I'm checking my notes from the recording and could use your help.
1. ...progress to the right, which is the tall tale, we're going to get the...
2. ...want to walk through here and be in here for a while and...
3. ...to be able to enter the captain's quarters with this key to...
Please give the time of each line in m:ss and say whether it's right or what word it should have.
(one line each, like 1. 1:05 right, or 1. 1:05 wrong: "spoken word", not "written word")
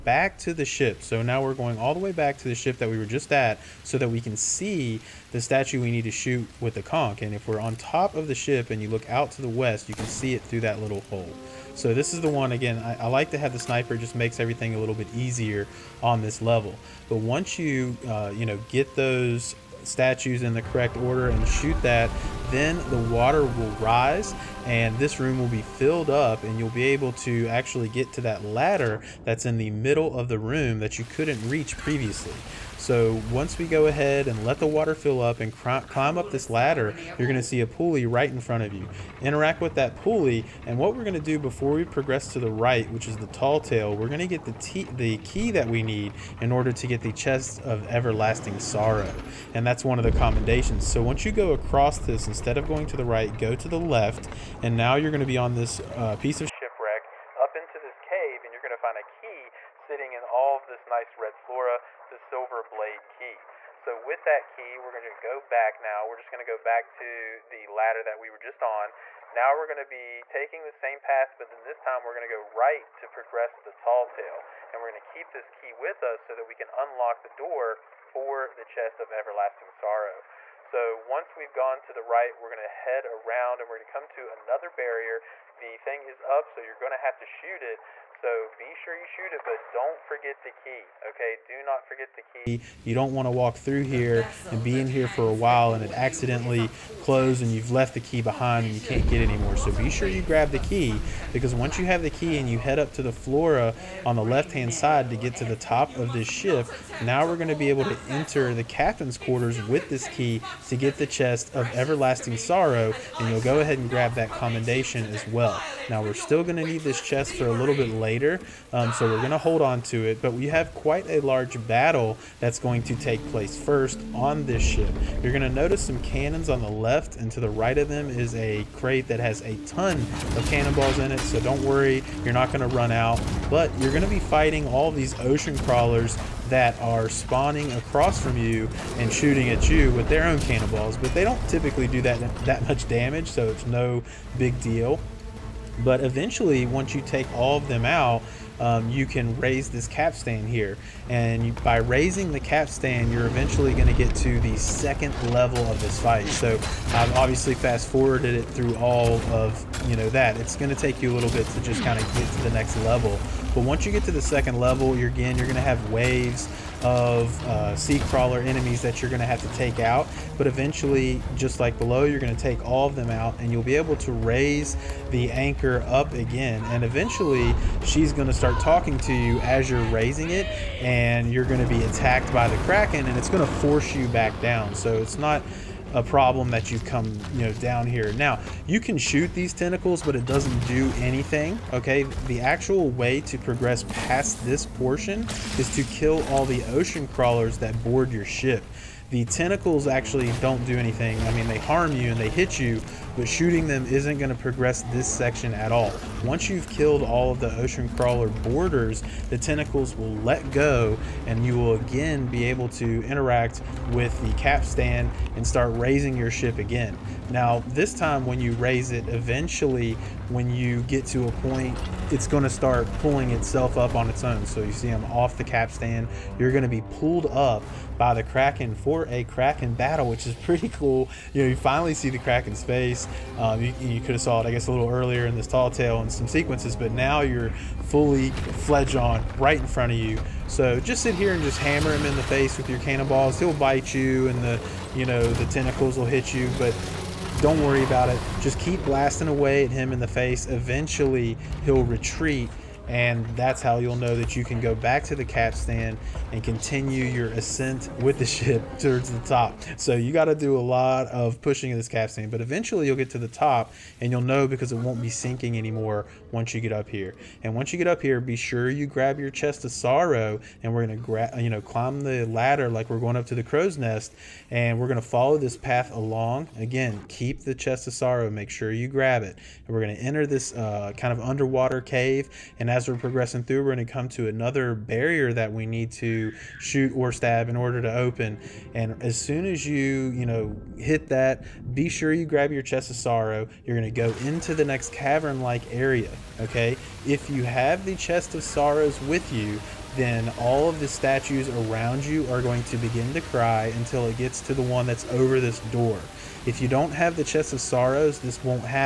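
1. 0:41 right
2. 1:33 right
3. 1:47 right.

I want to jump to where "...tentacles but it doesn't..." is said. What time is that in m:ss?
3:09.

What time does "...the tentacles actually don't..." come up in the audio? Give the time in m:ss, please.
3:19.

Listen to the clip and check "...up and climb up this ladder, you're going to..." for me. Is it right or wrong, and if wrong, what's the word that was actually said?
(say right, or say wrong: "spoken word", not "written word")
right.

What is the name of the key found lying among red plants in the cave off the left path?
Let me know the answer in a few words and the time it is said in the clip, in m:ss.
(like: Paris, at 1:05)
Silver blade key, at 1:02.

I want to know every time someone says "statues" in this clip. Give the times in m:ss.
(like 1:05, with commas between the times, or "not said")
0:05, 0:19, 5:00.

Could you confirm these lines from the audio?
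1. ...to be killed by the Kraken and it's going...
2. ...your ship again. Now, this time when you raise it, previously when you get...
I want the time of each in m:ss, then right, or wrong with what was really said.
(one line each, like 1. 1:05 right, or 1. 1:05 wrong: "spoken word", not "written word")
1. 3:01 wrong: "attacked", not "killed"
2. 3:36 wrong: "eventually", not "previously".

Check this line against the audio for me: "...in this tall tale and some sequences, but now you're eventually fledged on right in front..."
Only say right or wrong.
wrong.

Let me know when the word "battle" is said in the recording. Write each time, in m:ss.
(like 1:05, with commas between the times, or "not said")
2:01, 3:49.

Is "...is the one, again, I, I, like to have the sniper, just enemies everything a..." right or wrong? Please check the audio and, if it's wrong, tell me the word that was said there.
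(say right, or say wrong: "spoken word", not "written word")
wrong: "makes", not "enemies".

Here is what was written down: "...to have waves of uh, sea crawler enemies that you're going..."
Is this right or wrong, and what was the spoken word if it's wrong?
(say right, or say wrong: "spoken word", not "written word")
right.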